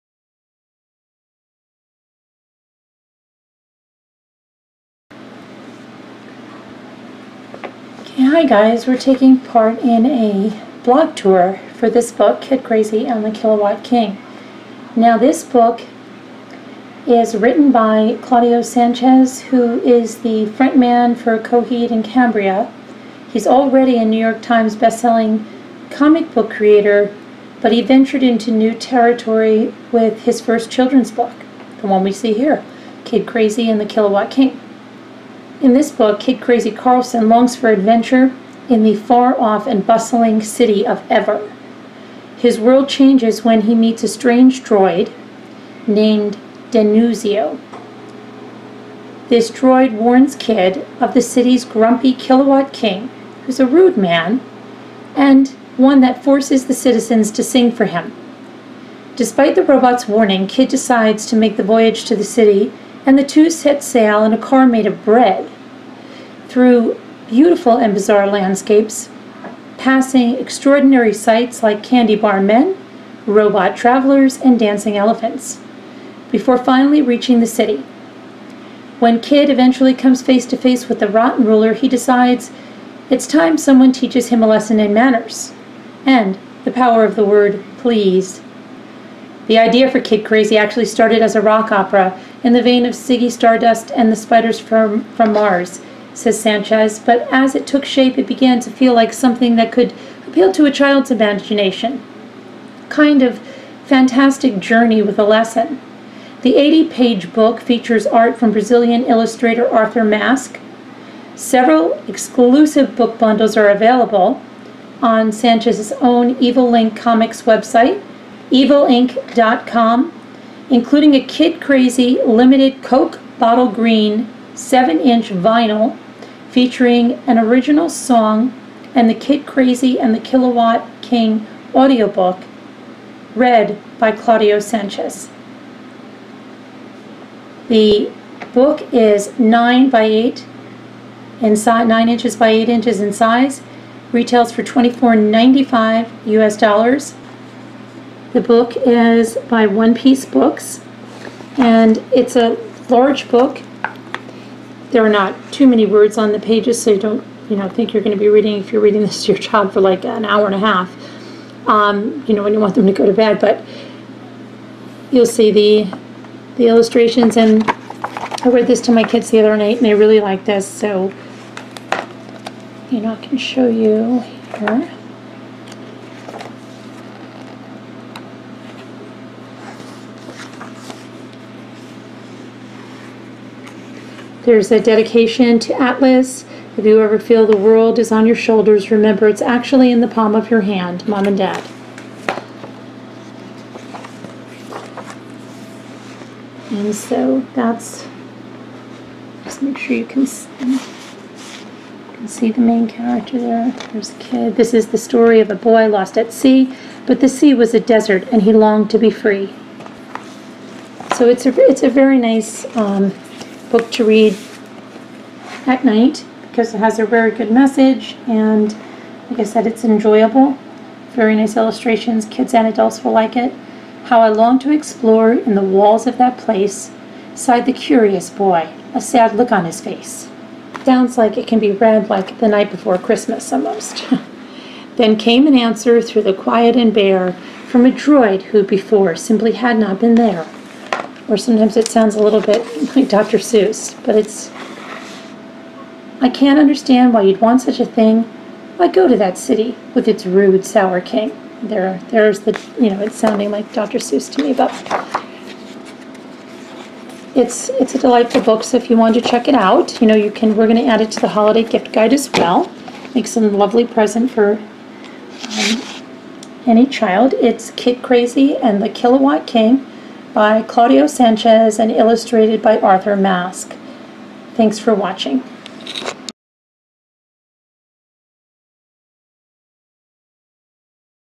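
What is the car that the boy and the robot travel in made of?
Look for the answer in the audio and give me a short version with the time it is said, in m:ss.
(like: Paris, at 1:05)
bread, at 1:05.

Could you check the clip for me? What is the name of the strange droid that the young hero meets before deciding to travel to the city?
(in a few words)
Denuzio.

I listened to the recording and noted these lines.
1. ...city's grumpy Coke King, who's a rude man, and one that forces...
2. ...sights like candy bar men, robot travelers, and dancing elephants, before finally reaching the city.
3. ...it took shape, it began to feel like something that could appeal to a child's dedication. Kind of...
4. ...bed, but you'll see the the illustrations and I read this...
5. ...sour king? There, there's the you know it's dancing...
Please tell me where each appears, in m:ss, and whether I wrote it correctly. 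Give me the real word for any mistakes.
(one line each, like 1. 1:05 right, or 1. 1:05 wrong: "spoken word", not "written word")
1. 0:51 wrong: "Kilowatt", not "Coke"
2. 1:11 right
3. 1:37 wrong: "imagination", not "dedication"
4. 2:43 right
5. 4:10 wrong: "sounding", not "dancing".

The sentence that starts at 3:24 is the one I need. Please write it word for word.
This is the story of a boy lost at sea, but the sea was a desert and he longed to be free.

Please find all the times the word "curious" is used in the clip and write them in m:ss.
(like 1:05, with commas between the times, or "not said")
3:47.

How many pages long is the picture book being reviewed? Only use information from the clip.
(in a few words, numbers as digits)
80.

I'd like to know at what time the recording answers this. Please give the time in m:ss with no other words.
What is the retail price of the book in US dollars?
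2:24.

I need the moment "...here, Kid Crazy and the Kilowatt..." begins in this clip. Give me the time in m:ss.
0:32.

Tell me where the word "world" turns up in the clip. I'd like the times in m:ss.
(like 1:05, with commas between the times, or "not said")
0:42, 3:07.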